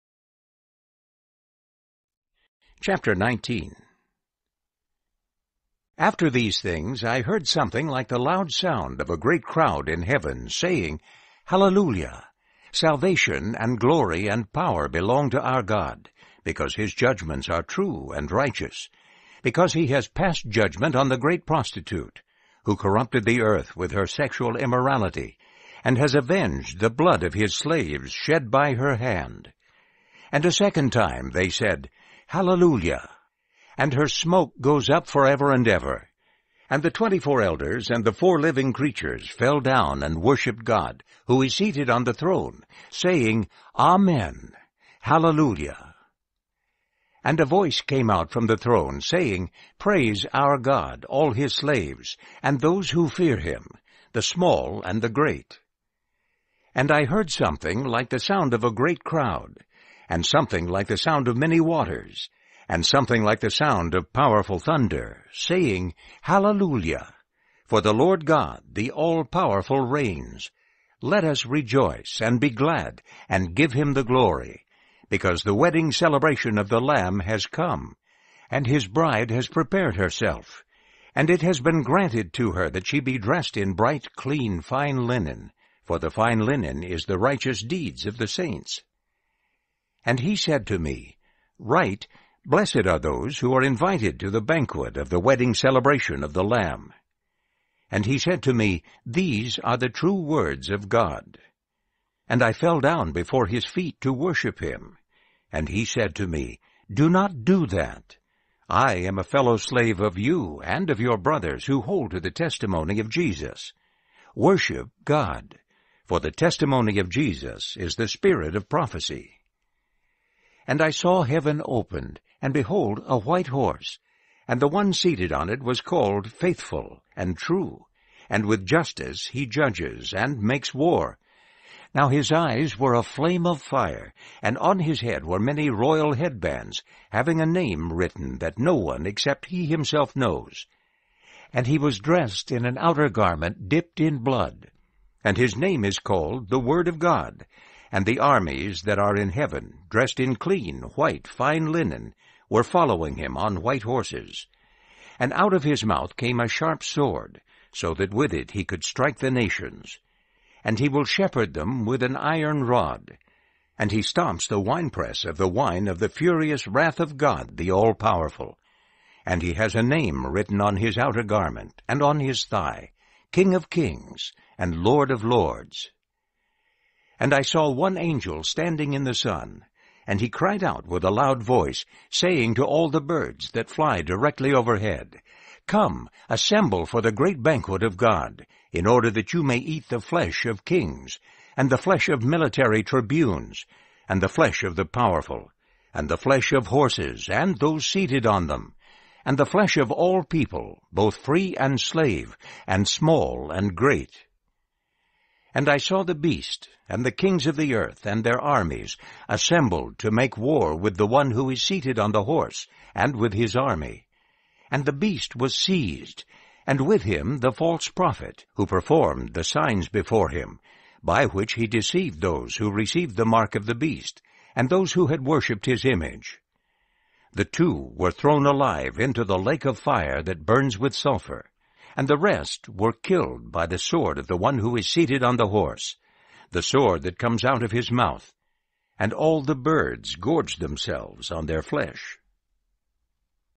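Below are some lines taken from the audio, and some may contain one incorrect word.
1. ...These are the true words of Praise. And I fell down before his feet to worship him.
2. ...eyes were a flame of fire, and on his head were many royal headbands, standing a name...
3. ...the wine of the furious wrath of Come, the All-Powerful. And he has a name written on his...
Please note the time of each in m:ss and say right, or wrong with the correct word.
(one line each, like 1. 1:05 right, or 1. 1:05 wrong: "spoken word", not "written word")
1. 1:39 wrong: "God", not "Praise"
2. 2:12 wrong: "having", not "standing"
3. 2:45 wrong: "God", not "Come".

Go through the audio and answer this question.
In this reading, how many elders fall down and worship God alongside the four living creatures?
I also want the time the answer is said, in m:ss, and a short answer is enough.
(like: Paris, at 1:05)
24, at 0:36.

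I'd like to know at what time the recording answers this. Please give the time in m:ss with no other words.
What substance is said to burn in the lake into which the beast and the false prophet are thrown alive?
3:50.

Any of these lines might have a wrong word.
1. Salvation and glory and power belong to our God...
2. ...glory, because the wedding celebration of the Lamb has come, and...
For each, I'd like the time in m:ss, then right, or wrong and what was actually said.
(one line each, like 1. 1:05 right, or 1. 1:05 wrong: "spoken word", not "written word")
1. 0:12 right
2. 1:14 right.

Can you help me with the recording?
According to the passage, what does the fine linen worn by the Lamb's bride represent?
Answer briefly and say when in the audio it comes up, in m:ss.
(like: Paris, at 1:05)
The righteous deeds of the saints, at 1:27.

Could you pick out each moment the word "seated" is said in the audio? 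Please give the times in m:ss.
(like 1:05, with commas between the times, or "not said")
0:41, 2:04, 3:17, 3:31, 3:54.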